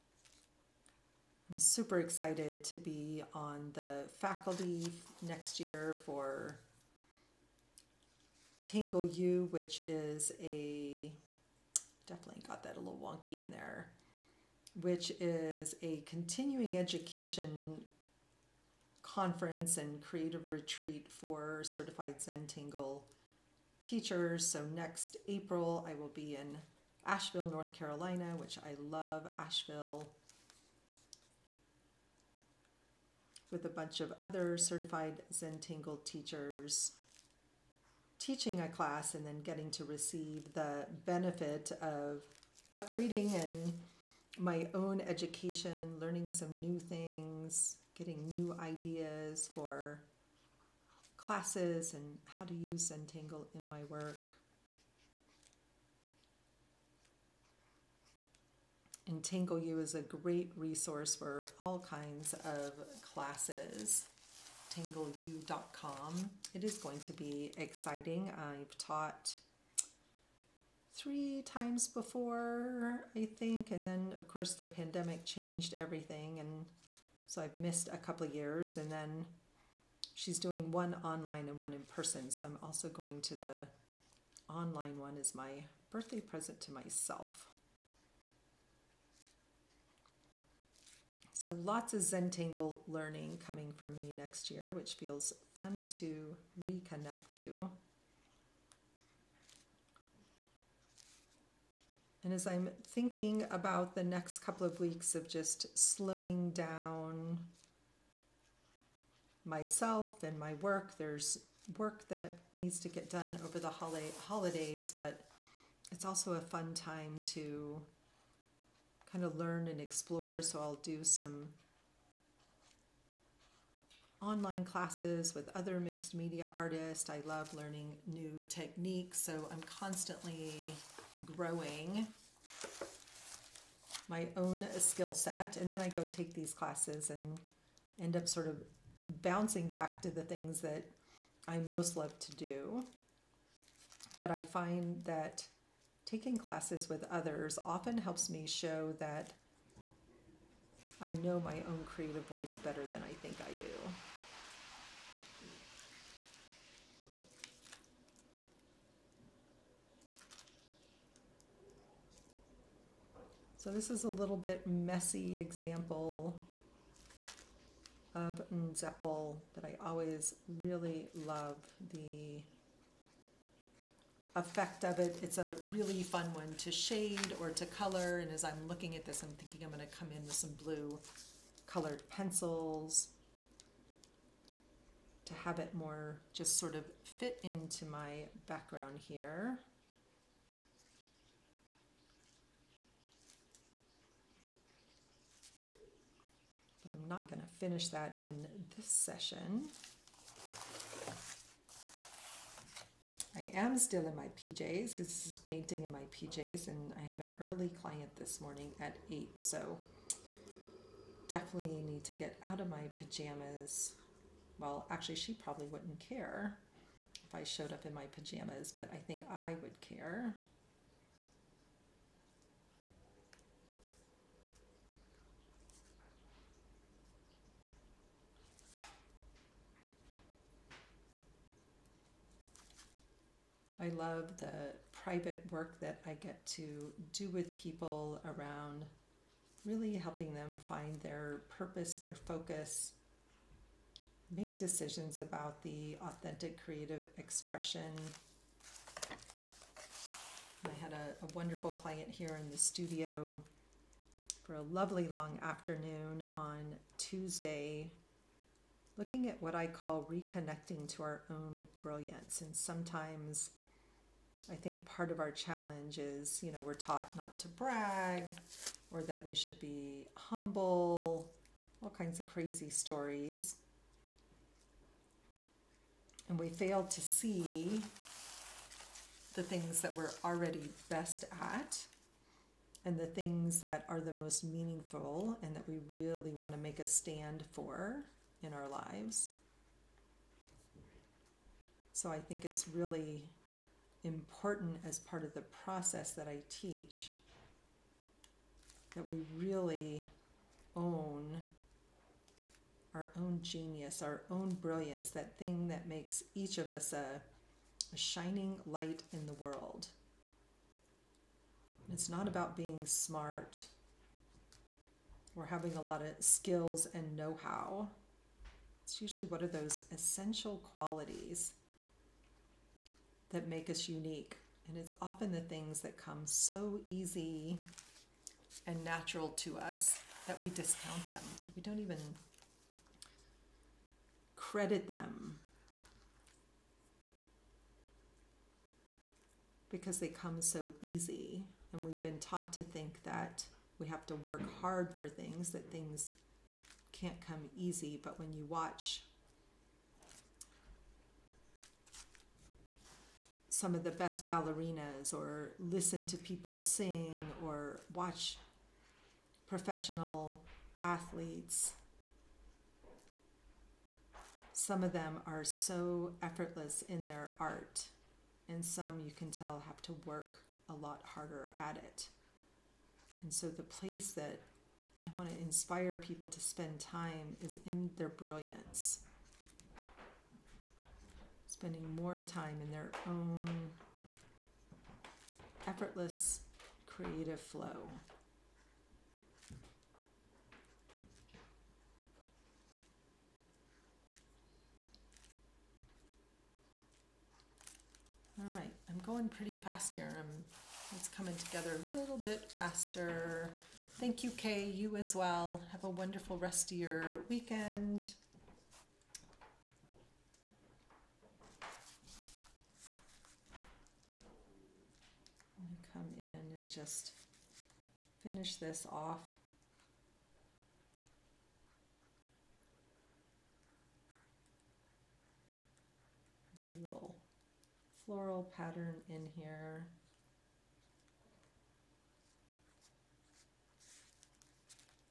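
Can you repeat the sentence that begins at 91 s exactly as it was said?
So lots of Zentangle learning coming for me next year, which feels fun to reconnect to.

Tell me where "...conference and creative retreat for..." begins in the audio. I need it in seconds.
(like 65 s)
19 s.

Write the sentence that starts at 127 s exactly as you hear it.
I love learning new techniques, so I'm constantly growing my own skill set.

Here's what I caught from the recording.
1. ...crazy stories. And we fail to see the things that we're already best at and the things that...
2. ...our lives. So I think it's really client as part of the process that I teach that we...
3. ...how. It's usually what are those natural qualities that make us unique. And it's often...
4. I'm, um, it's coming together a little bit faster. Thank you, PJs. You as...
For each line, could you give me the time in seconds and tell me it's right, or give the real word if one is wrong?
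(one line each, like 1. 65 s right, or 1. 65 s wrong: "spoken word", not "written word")
1. 272 s right
2. 288 s wrong: "important", not "client"
3. 317 s wrong: "essential", not "natural"
4. 400 s wrong: "Kay", not "PJs".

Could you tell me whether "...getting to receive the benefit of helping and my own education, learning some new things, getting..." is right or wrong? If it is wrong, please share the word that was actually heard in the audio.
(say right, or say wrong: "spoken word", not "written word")
wrong: "upgrading", not "helping".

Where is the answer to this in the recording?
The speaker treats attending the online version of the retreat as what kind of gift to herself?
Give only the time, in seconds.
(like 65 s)
85 s.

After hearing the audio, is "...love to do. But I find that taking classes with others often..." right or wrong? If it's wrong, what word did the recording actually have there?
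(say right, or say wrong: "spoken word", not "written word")
right.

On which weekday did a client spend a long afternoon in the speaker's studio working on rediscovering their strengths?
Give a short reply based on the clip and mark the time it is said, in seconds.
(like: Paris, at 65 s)
Tuesday, at 256 s.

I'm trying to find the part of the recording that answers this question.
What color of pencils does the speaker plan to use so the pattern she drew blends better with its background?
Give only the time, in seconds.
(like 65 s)
180 s.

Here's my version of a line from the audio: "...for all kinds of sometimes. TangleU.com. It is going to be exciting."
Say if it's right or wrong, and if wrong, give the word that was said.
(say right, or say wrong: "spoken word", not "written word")
wrong: "classes", not "sometimes".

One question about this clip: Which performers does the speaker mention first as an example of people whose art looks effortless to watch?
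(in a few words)
Ballerinas.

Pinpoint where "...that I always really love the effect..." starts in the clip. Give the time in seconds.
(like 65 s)
169 s.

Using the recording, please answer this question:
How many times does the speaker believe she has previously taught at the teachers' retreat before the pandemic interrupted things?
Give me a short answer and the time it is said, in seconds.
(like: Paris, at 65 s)
3, at 70 s.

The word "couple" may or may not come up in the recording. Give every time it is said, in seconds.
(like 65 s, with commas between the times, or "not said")
77 s, 104 s.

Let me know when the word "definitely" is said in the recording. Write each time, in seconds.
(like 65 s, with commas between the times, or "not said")
12 s, 211 s.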